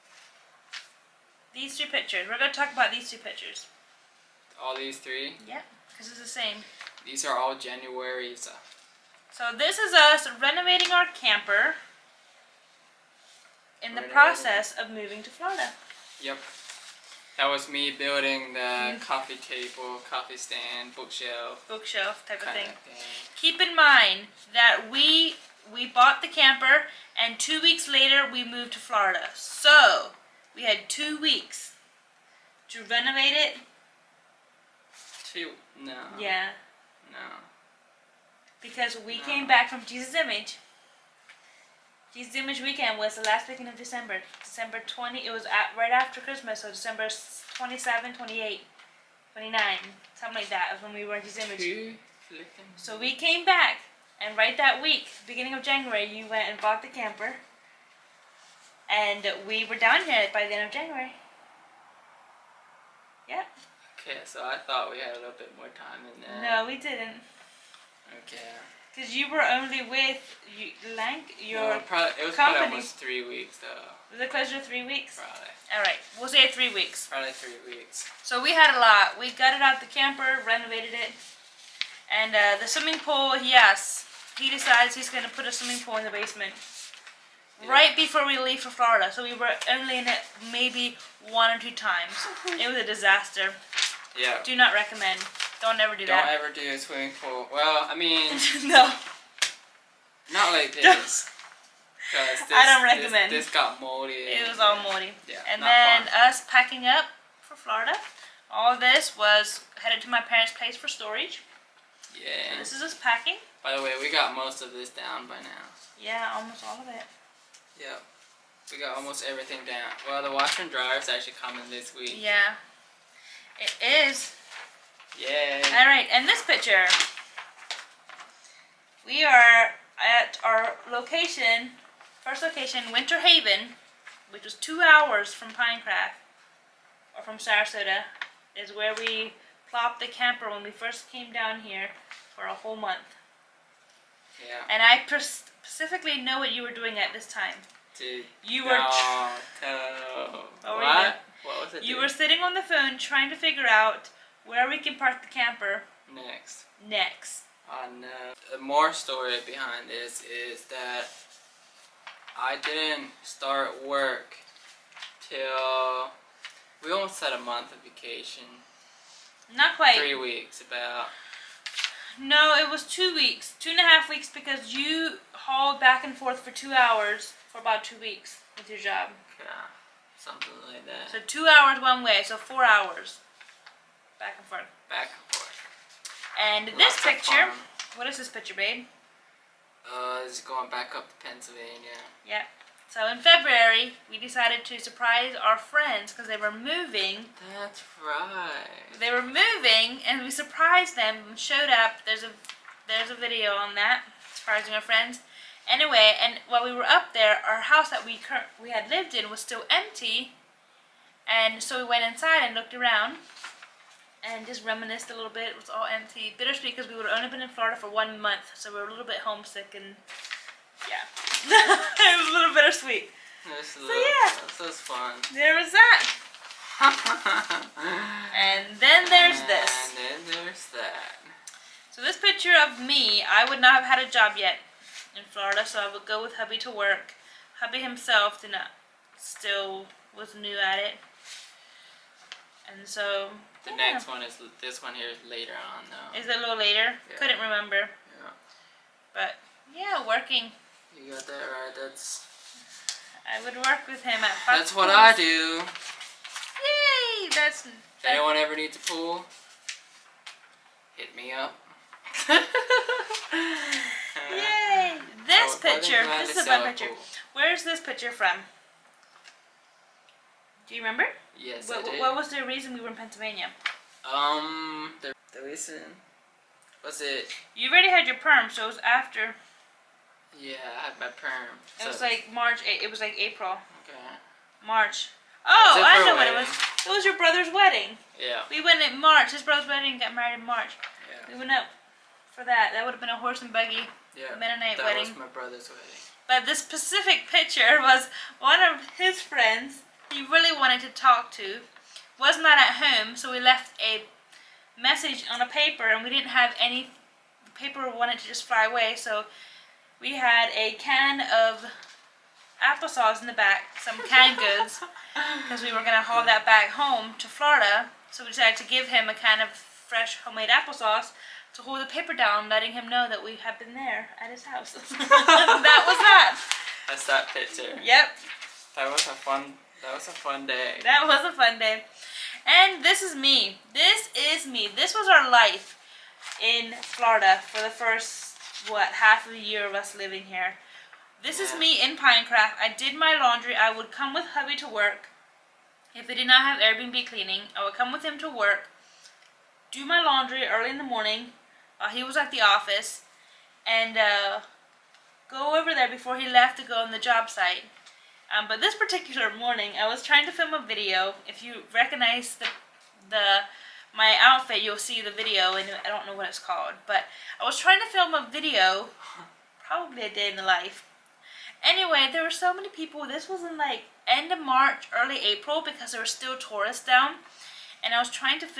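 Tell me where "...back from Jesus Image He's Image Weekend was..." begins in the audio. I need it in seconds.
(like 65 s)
39 s.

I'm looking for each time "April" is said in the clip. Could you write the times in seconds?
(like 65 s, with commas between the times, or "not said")
283 s, 375 s.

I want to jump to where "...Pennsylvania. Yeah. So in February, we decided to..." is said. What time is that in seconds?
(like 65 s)
191 s.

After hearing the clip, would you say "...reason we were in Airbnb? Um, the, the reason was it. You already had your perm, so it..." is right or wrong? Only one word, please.
wrong.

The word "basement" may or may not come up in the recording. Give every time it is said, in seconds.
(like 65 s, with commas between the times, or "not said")
86 s.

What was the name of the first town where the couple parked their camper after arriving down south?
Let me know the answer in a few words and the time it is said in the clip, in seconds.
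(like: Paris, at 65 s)
Winter Haven, at 132 s.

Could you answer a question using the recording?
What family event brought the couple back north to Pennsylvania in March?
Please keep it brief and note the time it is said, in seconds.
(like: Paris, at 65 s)
His brother's wedding, at 287 s.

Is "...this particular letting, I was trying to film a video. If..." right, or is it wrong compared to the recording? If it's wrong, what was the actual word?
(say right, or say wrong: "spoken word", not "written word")
wrong: "morning", not "letting".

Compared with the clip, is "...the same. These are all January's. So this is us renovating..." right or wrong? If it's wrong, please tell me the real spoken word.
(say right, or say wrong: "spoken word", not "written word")
right.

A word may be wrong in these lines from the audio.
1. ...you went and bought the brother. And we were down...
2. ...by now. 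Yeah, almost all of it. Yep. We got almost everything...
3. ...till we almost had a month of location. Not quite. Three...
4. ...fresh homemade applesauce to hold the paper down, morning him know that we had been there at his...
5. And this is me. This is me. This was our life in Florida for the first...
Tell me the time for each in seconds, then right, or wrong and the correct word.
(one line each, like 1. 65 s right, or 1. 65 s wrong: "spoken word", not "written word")
1. 56 s wrong: "camper", not "brother"
2. 115 s right
3. 165 s wrong: "vacation", not "location"
4. 319 s wrong: "letting", not "morning"
5. 332 s right.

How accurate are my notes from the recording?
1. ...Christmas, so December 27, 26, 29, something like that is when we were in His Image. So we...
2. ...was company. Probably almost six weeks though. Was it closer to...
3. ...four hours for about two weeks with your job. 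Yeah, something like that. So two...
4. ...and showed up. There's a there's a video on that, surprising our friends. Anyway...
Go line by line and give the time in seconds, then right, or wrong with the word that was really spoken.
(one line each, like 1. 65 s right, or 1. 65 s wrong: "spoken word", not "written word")
1. 46 s wrong: "28", not "26"
2. 72 s wrong: "three", not "six"
3. 176 s wrong: "two", not "four"
4. 201 s right.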